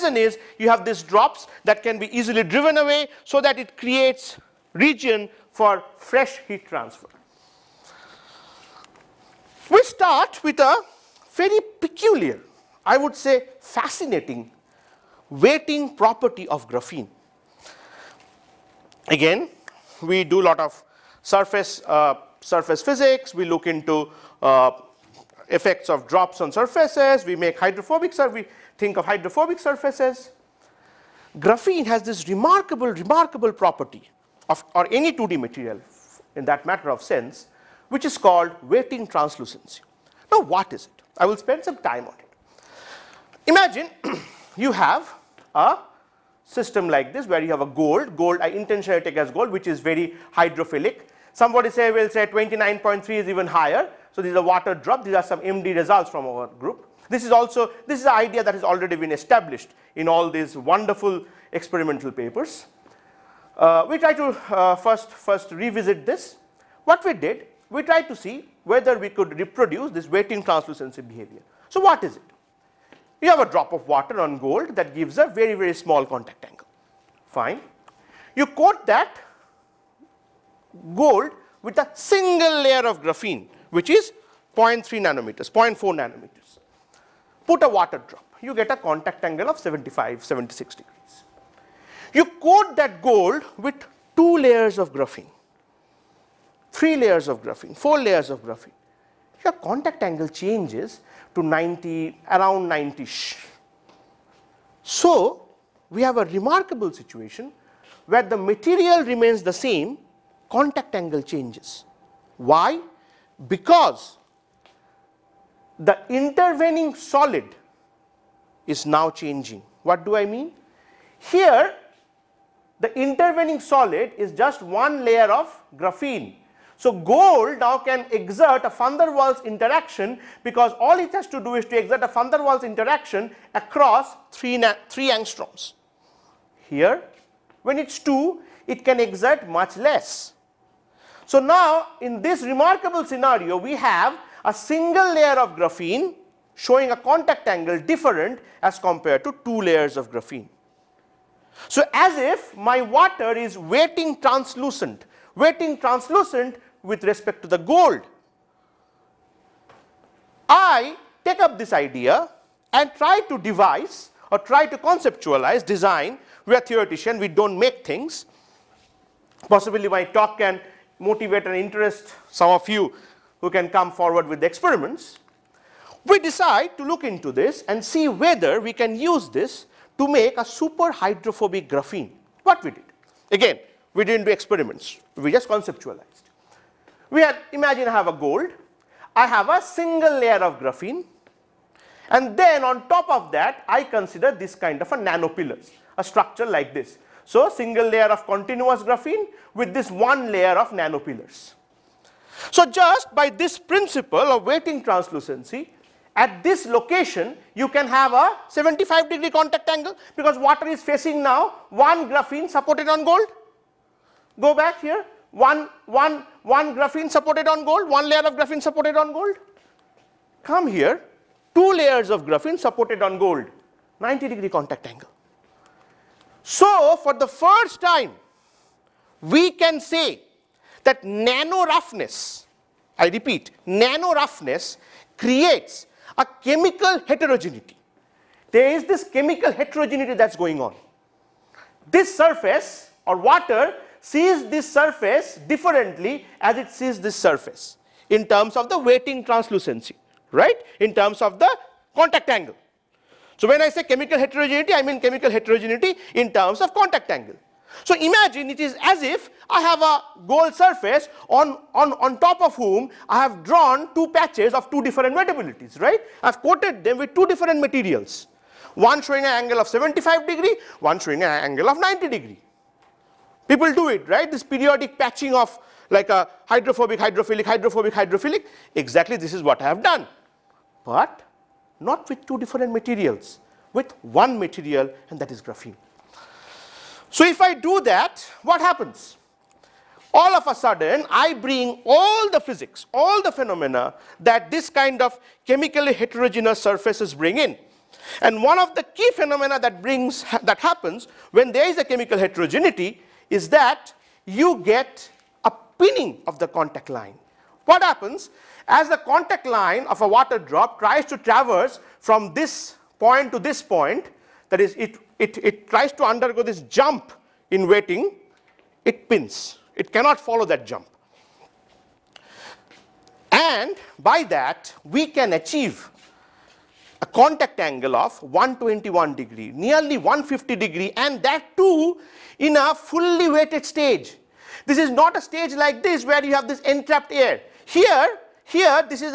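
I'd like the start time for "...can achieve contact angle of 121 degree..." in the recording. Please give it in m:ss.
5:25.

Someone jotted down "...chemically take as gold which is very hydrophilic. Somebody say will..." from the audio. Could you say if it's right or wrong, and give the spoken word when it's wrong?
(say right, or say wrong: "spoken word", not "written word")
wrong: "intentionally", not "chemically".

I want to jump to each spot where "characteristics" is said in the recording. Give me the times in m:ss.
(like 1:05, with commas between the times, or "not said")
not said.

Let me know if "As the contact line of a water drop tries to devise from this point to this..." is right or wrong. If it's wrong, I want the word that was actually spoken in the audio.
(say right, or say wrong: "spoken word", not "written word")
wrong: "traverse", not "devise".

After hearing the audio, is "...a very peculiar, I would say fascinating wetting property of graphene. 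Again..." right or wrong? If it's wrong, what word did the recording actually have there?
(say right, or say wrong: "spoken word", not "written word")
right.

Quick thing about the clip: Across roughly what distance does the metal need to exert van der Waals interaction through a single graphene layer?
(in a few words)
3 angstroms.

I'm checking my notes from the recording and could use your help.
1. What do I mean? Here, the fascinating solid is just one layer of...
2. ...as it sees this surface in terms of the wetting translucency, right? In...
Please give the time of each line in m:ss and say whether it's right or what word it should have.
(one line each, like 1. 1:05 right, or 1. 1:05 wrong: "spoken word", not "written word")
1. 1:59 wrong: "intervening", not "fascinating"
2. 4:06 right.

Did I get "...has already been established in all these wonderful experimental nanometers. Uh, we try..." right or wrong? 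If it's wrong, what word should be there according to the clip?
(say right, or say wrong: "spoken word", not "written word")
wrong: "papers", not "nanometers".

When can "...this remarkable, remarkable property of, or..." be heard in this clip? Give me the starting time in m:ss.
0:32.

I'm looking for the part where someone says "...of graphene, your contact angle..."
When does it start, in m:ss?
1:38.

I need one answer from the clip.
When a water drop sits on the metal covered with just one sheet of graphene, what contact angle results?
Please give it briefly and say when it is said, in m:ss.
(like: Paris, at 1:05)
75, 76 degrees, at 1:29.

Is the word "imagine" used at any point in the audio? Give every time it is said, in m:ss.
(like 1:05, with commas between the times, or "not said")
0:43, 3:07, 4:17.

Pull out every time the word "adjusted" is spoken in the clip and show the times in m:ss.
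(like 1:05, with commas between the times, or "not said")
not said.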